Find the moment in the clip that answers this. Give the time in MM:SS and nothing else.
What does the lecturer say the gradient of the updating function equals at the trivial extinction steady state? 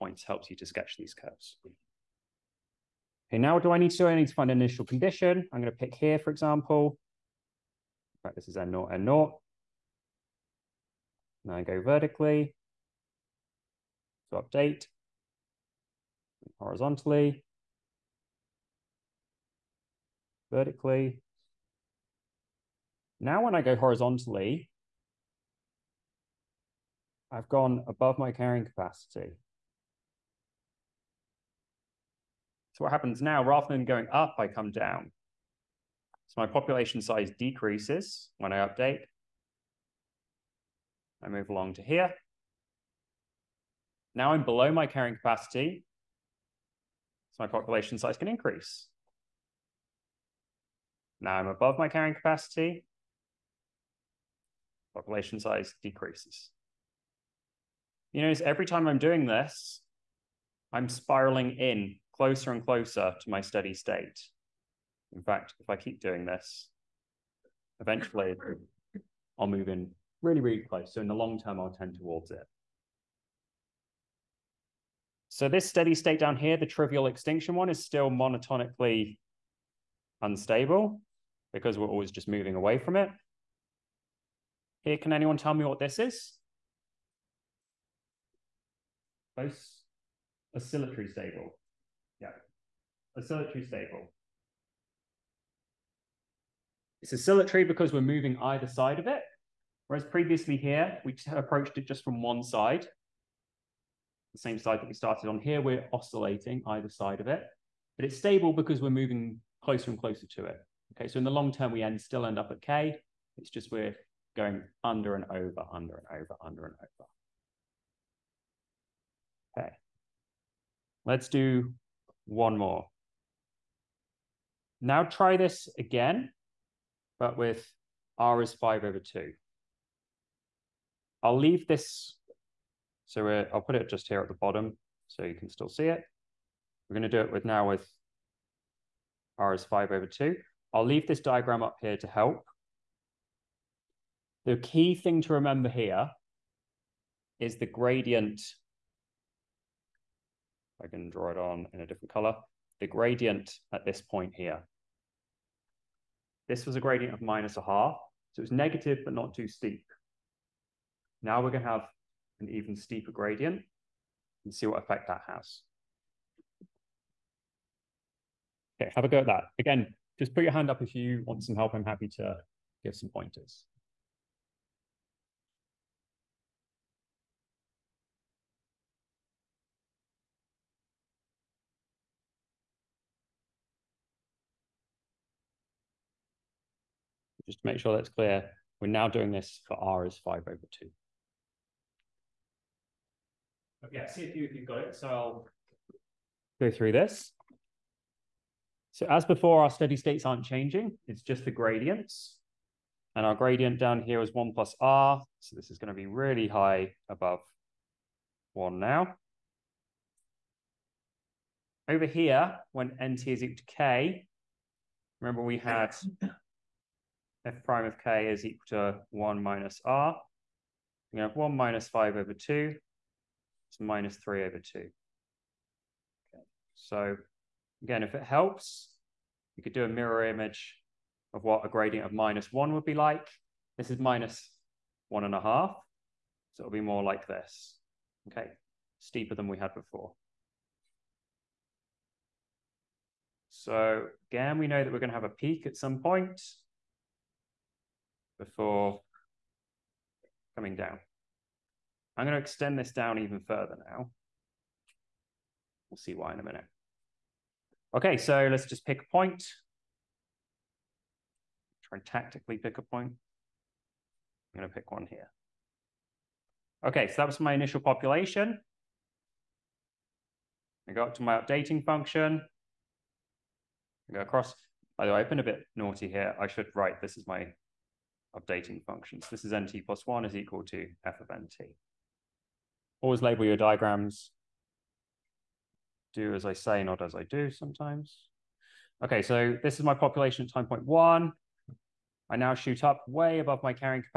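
03:24.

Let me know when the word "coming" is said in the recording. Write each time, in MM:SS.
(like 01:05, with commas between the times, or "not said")
04:10.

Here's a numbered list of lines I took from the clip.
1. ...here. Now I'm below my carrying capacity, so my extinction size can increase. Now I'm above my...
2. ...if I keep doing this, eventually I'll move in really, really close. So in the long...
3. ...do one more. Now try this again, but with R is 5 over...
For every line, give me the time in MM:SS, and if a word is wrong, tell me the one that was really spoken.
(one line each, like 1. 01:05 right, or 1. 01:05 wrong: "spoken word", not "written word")
1. 00:41 wrong: "population", not "extinction"
2. 01:05 right
3. 02:01 right.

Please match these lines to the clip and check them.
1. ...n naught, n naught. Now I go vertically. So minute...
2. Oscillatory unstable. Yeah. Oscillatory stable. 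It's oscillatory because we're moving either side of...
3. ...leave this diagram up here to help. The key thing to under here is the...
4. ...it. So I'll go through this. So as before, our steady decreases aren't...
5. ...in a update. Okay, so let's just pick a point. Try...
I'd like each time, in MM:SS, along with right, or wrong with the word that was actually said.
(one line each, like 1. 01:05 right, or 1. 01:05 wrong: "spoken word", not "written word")
1. 00:08 wrong: "update", not "minute"
2. 01:30 wrong: "stable", not "unstable"
3. 02:20 wrong: "remember", not "under"
4. 03:14 wrong: "states", not "decreases"
5. 04:16 wrong: "minute", not "update".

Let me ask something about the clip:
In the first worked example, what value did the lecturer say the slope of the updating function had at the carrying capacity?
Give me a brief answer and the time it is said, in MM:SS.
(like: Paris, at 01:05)
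-1/2, at 02:37.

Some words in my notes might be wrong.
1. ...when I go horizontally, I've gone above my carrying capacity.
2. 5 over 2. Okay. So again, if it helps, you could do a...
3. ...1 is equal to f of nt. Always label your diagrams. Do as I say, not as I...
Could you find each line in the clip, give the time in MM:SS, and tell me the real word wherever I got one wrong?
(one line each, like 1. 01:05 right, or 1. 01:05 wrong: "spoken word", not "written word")
1. 00:23 right
2. 03:43 wrong: "3", not "5"
3. 04:40 right.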